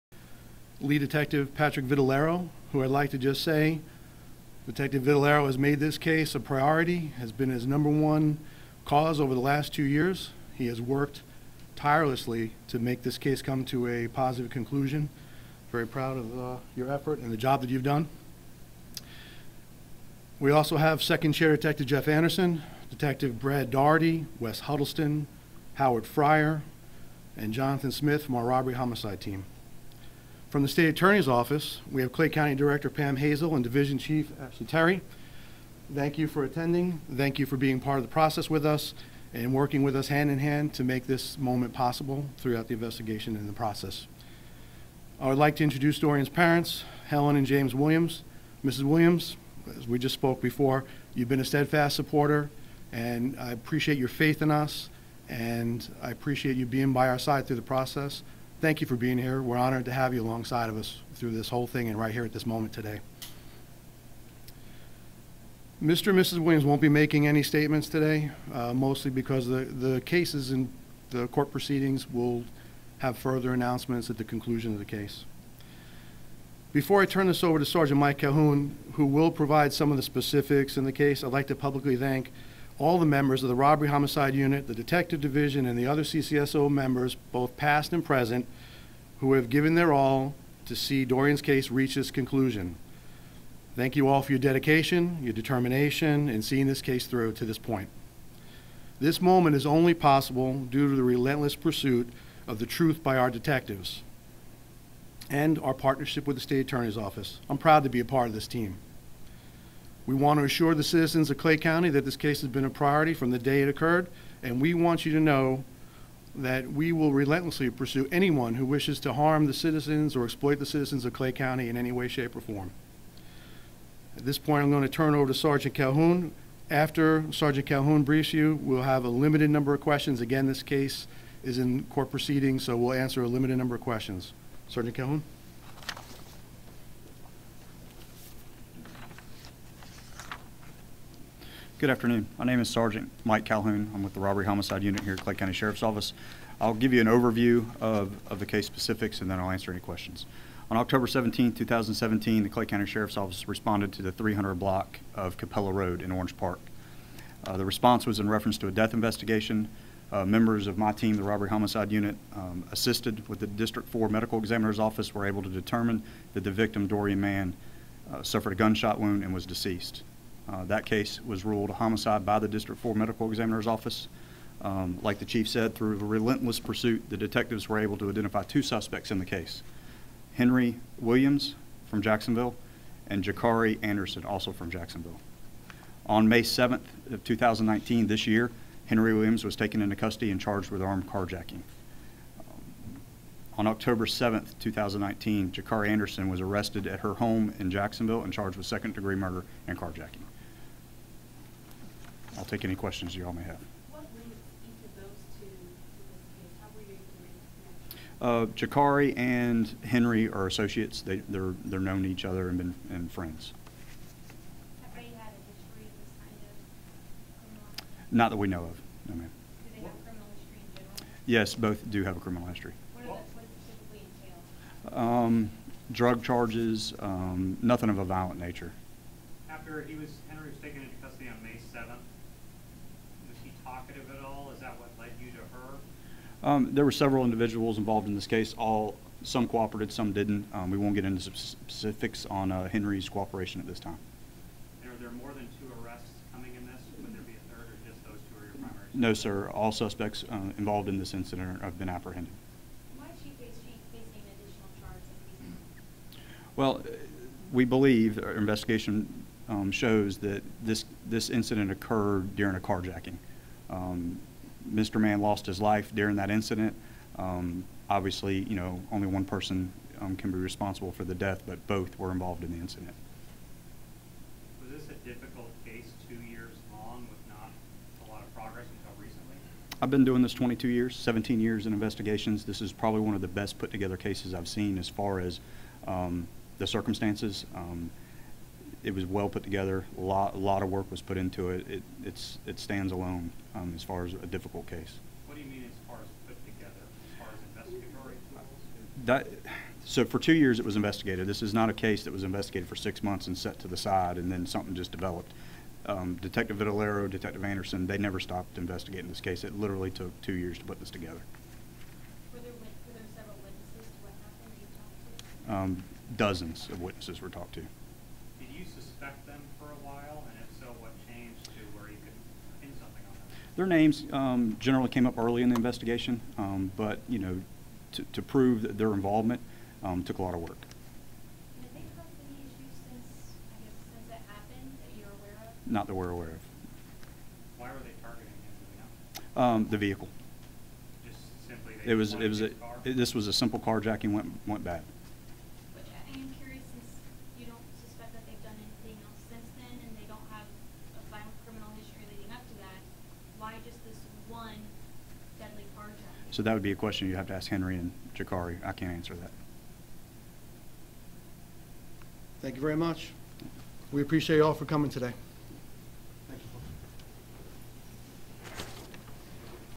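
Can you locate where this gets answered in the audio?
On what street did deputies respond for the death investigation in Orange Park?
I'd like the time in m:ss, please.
2:35.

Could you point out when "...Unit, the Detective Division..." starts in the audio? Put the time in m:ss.
1:24.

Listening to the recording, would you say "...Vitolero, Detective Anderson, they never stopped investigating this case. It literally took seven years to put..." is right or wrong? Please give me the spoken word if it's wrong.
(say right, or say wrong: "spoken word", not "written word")
wrong: "two", not "seven".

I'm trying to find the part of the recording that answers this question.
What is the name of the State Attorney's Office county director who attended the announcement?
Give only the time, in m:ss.
0:32.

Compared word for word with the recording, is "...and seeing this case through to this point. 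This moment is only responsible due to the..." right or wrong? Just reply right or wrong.
wrong.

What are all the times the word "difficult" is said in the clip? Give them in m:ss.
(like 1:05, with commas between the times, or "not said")
4:35, 4:54.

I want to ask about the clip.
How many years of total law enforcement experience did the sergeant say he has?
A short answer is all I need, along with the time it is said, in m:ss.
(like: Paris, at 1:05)
22, at 4:40.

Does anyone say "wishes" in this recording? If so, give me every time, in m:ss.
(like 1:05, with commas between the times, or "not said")
1:58.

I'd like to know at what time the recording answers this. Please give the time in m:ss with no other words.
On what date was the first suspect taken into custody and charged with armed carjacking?
3:06.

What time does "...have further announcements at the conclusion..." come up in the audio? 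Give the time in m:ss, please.
1:12.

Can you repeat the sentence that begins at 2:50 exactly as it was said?
Uh, that case was ruled a homicide by the District 4 Medical Examiner's Office.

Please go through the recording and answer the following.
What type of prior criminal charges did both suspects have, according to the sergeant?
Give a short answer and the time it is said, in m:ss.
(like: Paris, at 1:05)
Drug charges, at 3:45.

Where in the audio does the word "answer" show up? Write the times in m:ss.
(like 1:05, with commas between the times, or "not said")
2:12, 2:29, 5:58.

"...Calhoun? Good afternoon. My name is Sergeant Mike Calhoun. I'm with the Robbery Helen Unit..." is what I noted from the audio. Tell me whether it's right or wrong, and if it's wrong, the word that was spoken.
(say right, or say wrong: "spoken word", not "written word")
wrong: "Homicide", not "Helen".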